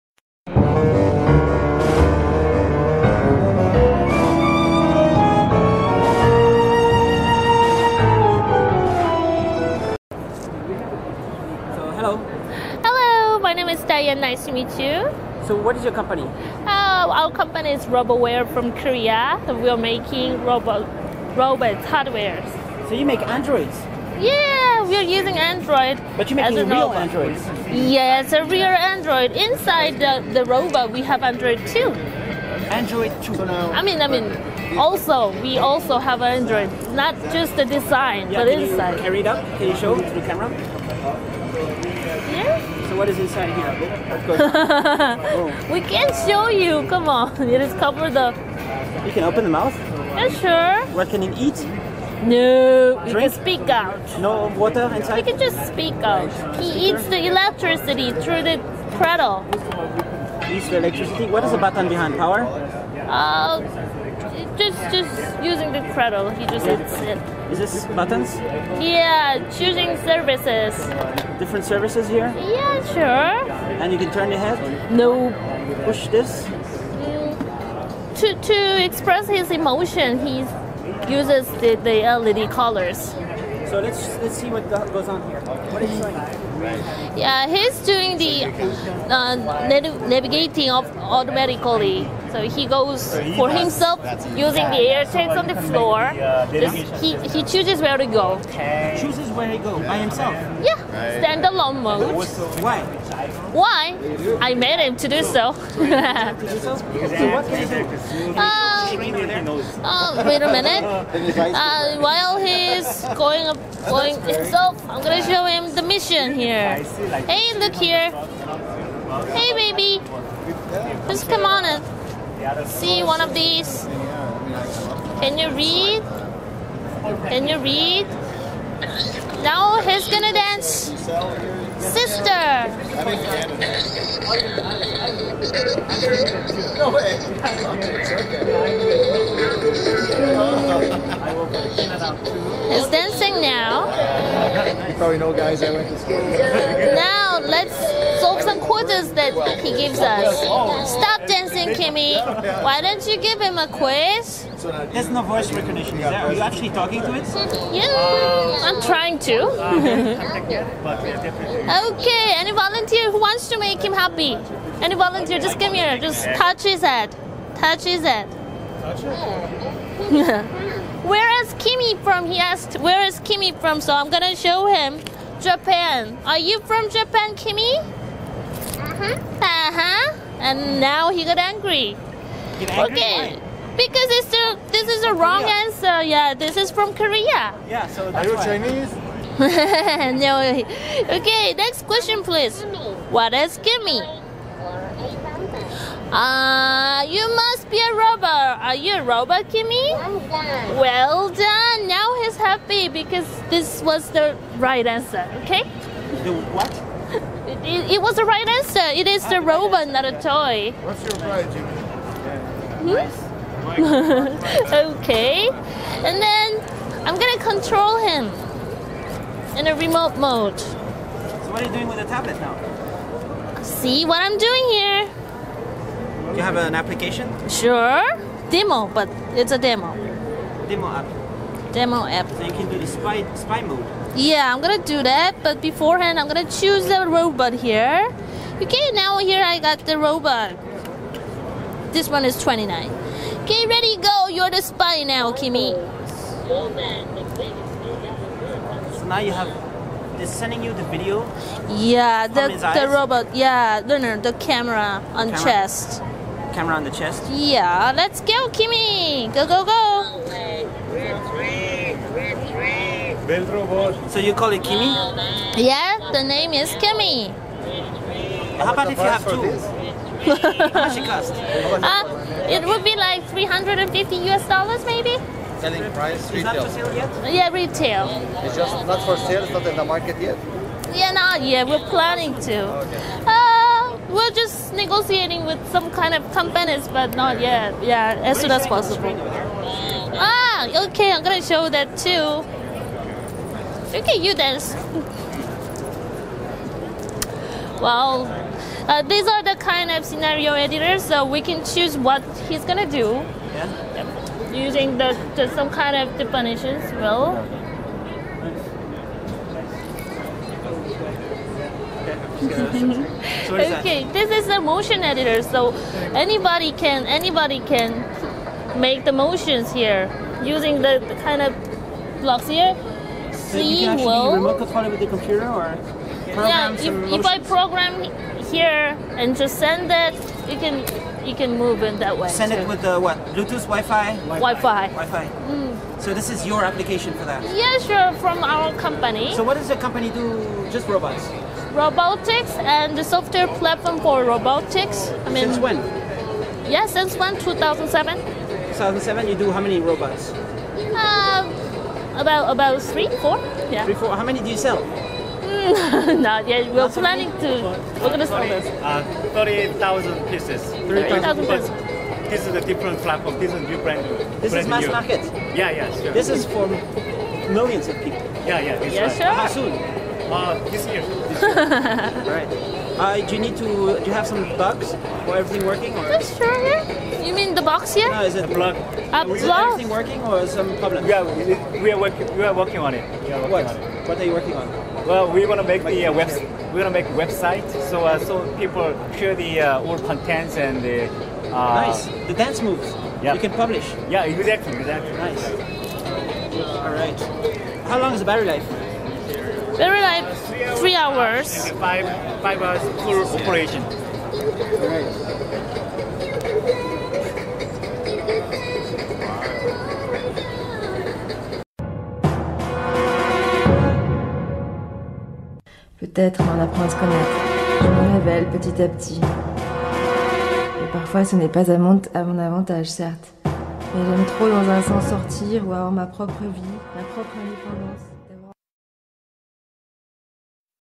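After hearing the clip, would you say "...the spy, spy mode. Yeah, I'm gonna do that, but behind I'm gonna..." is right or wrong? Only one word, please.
wrong.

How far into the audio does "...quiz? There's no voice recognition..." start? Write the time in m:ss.
2:33.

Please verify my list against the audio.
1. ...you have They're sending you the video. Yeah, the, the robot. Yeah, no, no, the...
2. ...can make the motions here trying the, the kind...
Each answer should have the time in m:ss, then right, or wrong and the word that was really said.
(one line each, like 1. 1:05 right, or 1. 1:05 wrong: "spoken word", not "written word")
1. 4:09 right
2. 5:17 wrong: "using", not "trying".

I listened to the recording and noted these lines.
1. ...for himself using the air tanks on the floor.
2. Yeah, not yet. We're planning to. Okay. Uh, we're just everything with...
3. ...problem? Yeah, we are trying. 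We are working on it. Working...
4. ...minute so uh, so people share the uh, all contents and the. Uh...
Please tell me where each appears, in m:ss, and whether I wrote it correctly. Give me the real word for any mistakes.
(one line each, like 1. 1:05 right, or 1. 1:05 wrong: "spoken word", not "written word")
1. 1:33 right
2. 4:40 wrong: "negotiating", not "everything"
3. 6:20 wrong: "working", not "trying"
4. 6:27 wrong: "website", not "minute".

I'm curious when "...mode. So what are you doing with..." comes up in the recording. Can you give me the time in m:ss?
3:40.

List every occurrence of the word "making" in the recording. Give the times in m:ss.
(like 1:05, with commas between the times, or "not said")
0:19, 0:26.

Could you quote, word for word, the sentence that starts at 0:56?
He eats the electricity through the cradle.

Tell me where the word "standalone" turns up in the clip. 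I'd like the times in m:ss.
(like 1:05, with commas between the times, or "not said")
1:41.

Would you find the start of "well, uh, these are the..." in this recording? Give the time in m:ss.
4:57.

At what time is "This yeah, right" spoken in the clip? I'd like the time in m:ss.
6:08.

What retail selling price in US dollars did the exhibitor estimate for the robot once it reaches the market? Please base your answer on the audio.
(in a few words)
$350.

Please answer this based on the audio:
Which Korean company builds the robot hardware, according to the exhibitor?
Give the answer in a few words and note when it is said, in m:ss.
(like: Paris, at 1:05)
Roboware, at 0:17.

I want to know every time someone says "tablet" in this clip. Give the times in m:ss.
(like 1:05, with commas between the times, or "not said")
3:42.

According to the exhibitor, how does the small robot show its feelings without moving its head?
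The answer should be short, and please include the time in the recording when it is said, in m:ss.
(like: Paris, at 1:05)
LED colors, at 1:22.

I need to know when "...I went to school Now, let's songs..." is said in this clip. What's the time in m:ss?
2:25.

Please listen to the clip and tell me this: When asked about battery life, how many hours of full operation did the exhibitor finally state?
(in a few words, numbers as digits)
5 hours.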